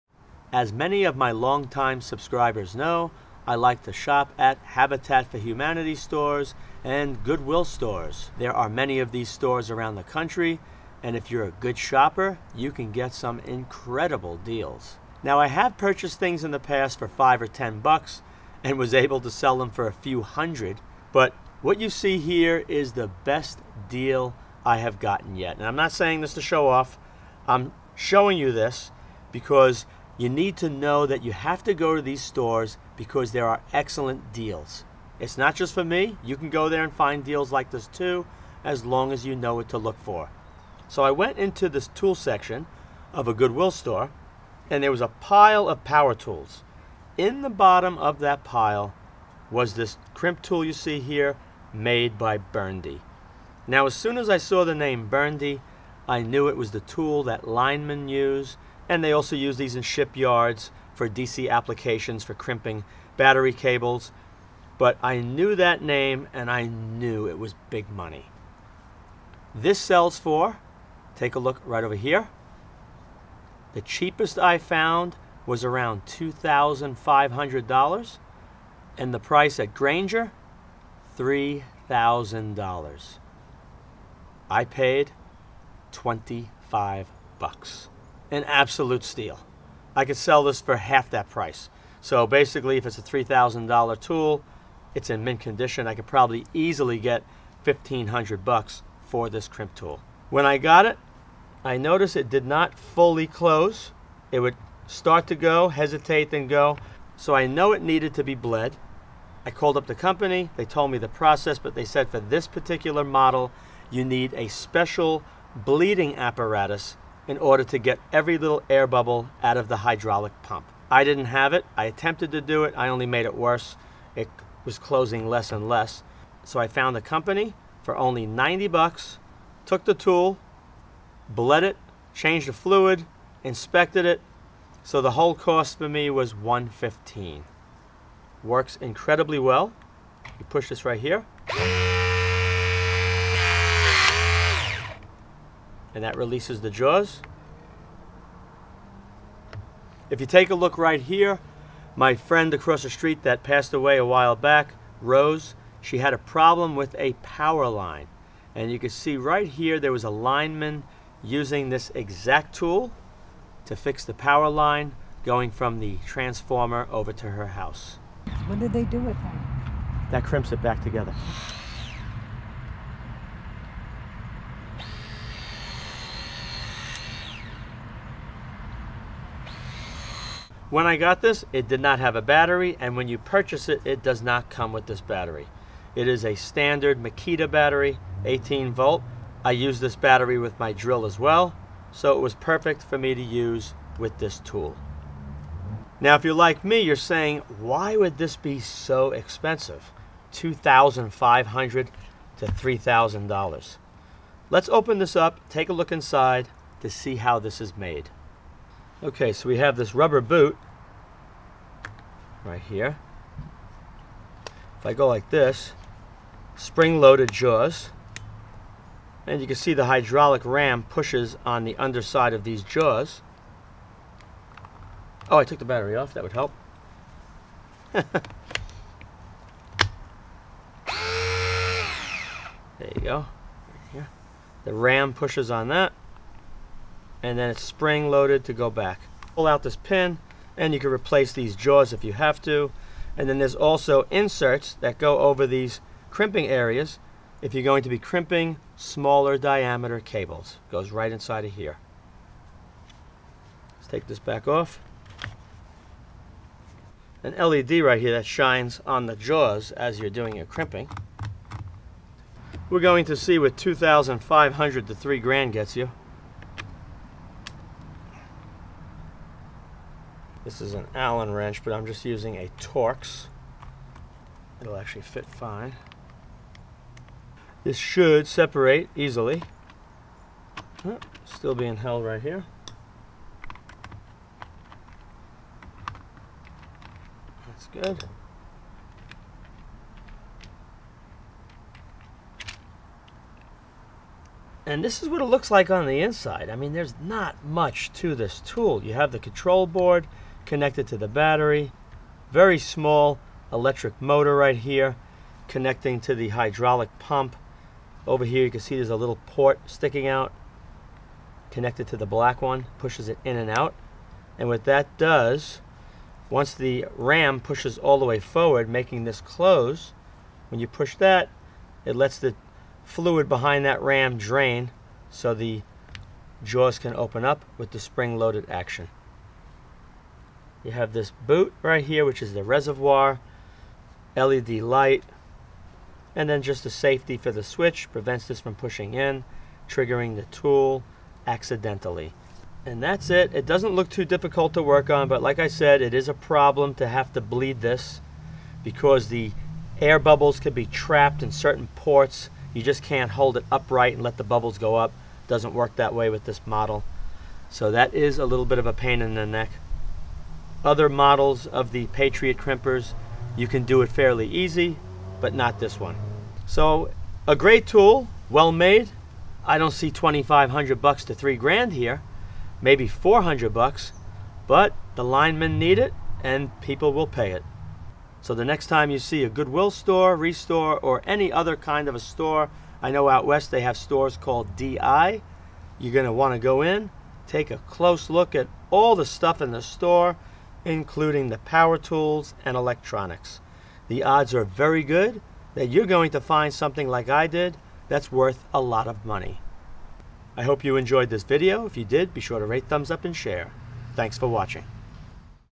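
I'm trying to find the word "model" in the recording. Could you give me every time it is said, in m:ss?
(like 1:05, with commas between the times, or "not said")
1:53, 5:56, 6:00.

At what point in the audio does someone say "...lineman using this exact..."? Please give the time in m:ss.
2:40.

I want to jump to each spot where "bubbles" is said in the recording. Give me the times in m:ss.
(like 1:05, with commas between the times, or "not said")
1:58, 5:49, 5:54.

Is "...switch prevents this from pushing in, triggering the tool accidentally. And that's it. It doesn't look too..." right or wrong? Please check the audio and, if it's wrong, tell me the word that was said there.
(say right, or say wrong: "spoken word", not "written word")
right.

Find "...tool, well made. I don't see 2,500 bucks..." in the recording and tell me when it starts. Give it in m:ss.
6:07.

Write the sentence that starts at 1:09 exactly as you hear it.
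This sells for, take a look right over here.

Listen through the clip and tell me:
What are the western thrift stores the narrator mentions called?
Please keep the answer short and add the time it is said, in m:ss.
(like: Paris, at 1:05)
DI, at 6:24.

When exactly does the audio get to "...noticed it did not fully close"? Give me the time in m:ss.
1:41.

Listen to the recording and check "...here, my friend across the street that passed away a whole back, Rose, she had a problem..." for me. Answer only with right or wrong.
wrong.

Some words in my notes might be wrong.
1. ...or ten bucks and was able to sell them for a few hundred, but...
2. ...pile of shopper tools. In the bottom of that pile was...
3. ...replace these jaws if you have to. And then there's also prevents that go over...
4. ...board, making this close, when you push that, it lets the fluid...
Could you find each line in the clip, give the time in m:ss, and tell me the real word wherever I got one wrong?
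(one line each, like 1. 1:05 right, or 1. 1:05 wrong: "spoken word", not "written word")
1. 0:17 right
2. 0:45 wrong: "power", not "shopper"
3. 4:00 wrong: "inserts", not "prevents"
4. 5:18 wrong: "forward", not "board".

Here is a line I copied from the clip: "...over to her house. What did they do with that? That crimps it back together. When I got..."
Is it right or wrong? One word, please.
right.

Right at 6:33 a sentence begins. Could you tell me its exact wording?
The odds are very good that you're going to find something like I did that's worth a lot of money.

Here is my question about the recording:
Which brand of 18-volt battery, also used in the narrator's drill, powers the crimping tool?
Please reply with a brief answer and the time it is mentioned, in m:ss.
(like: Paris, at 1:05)
Makita, at 3:07.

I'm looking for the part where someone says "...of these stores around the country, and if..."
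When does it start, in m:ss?
0:08.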